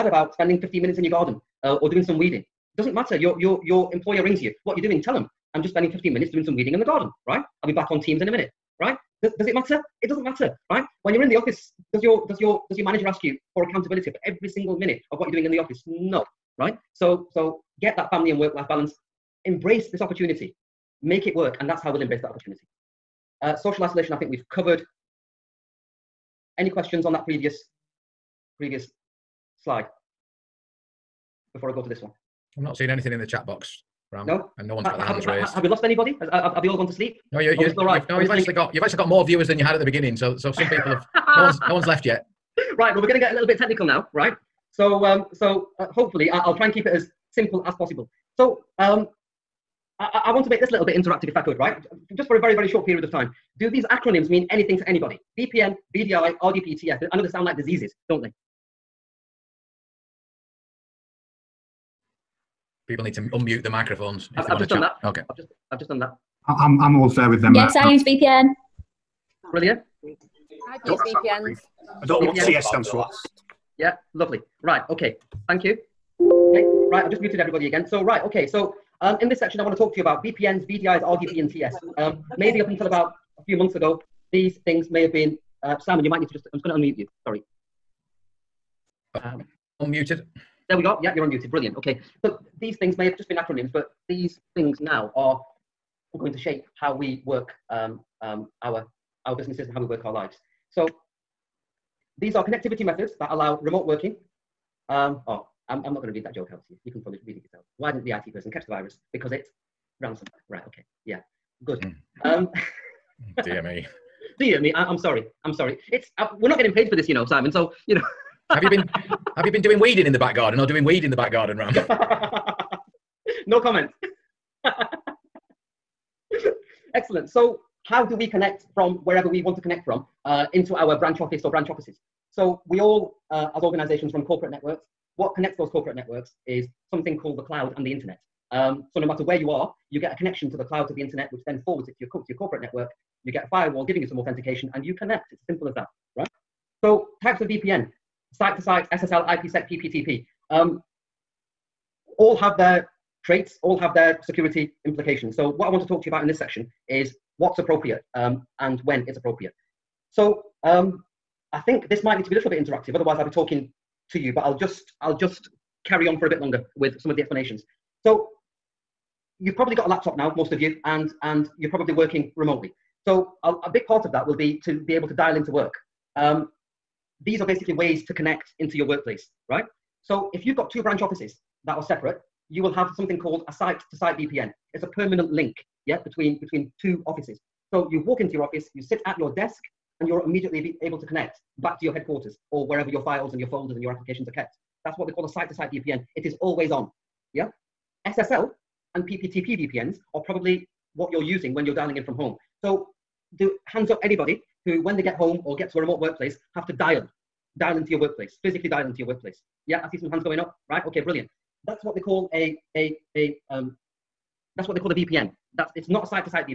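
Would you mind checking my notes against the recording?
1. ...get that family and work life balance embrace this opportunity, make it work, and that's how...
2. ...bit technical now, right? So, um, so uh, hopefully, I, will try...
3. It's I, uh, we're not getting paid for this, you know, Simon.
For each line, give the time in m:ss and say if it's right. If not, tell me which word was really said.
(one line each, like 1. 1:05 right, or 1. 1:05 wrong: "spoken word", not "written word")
1. 0:17 right
2. 0:43 right
3. 1:55 right.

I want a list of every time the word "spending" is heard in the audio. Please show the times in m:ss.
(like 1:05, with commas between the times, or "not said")
0:00, 0:05.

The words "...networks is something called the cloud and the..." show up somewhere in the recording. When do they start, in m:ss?
2:15.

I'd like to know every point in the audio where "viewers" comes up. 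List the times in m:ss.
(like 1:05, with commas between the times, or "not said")
0:39.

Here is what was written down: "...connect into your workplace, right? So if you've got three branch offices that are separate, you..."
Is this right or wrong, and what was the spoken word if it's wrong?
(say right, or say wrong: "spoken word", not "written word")
wrong: "two", not "three".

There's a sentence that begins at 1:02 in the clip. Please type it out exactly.
People need to unmute the microphones.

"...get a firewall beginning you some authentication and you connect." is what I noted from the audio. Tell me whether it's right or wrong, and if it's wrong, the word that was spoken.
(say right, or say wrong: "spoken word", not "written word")
wrong: "giving", not "beginning".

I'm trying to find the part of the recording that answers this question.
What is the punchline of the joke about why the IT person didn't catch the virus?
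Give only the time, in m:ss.
1:49.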